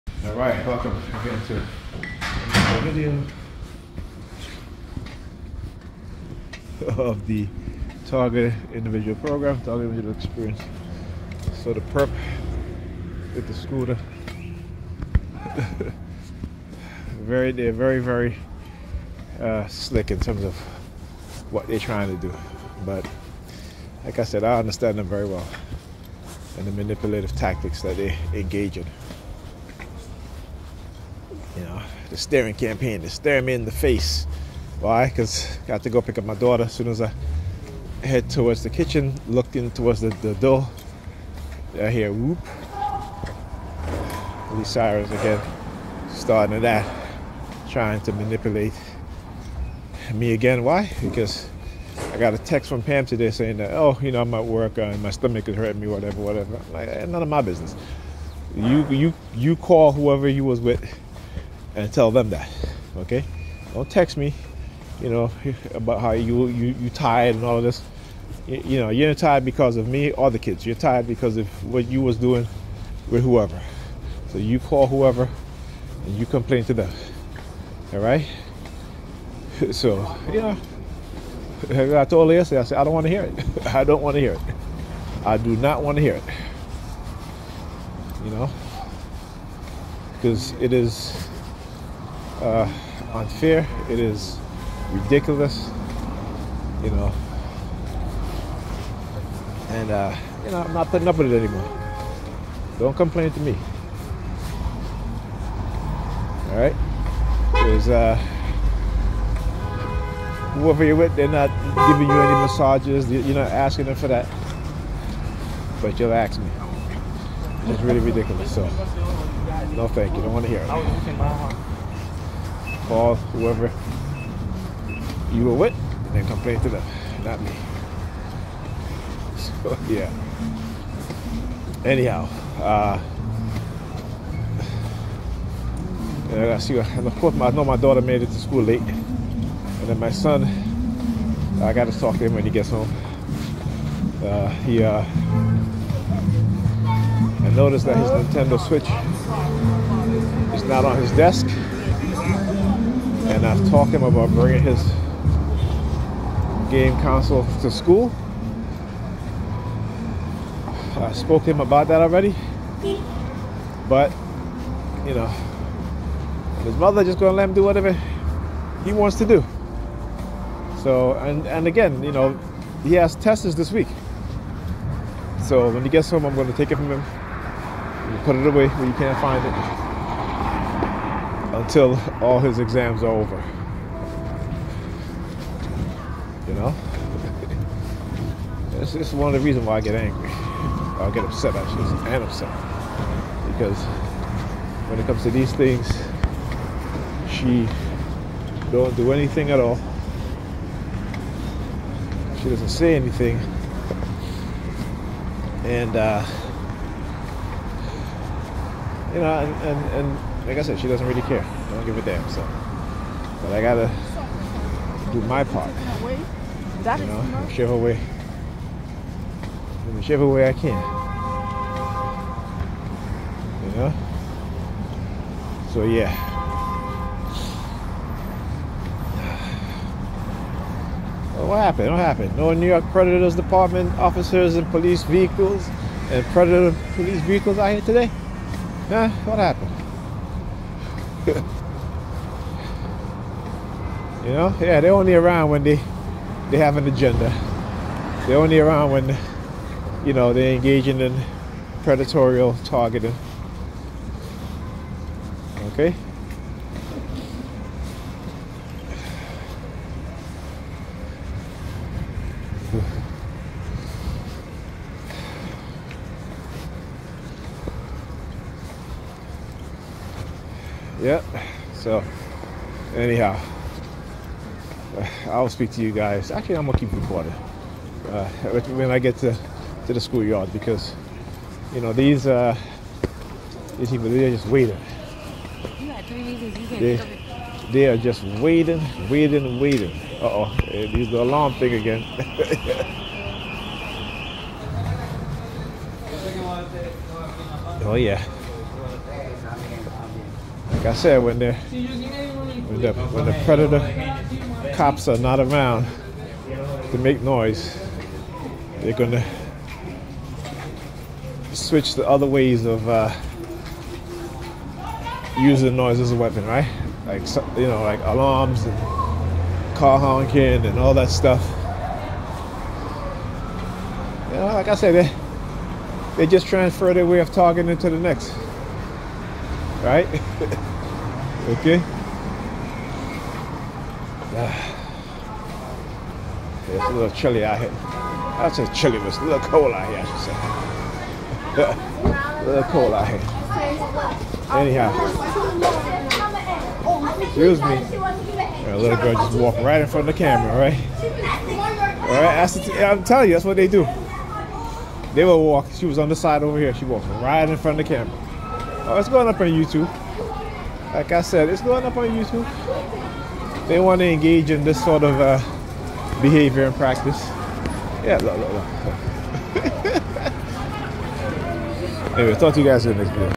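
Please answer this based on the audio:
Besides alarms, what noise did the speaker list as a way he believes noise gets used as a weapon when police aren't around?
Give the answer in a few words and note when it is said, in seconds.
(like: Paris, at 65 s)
car honking, at 319 s.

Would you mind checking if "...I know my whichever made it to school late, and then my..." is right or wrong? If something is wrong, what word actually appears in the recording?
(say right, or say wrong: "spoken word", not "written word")
wrong: "daughter", not "whichever".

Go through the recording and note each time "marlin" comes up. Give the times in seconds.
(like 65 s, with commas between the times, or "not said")
not said.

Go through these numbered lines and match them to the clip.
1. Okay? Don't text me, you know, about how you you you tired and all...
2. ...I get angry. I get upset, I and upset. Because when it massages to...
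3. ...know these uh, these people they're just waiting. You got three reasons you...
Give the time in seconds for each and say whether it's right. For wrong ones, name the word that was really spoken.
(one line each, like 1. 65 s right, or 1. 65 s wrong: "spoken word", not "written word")
1. 62 s right
2. 189 s wrong: "comes", not "massages"
3. 281 s right.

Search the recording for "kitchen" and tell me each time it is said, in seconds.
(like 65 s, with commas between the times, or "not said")
38 s.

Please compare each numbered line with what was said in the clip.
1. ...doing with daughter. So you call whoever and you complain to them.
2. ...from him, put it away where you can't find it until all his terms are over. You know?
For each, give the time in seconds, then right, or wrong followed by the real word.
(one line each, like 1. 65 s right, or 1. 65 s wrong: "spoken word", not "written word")
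1. 72 s wrong: "whoever", not "daughter"
2. 176 s wrong: "exams", not "terms".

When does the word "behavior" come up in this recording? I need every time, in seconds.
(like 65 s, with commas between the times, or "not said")
366 s.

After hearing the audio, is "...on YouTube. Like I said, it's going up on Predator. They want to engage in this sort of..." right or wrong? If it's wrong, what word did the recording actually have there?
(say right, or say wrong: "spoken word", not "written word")
wrong: "YouTube", not "Predator".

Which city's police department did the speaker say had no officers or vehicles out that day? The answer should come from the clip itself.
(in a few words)
New York.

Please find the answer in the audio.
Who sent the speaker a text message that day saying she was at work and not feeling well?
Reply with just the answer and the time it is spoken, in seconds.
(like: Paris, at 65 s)
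Pam, at 52 s.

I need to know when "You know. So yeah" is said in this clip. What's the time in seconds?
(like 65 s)
223 s.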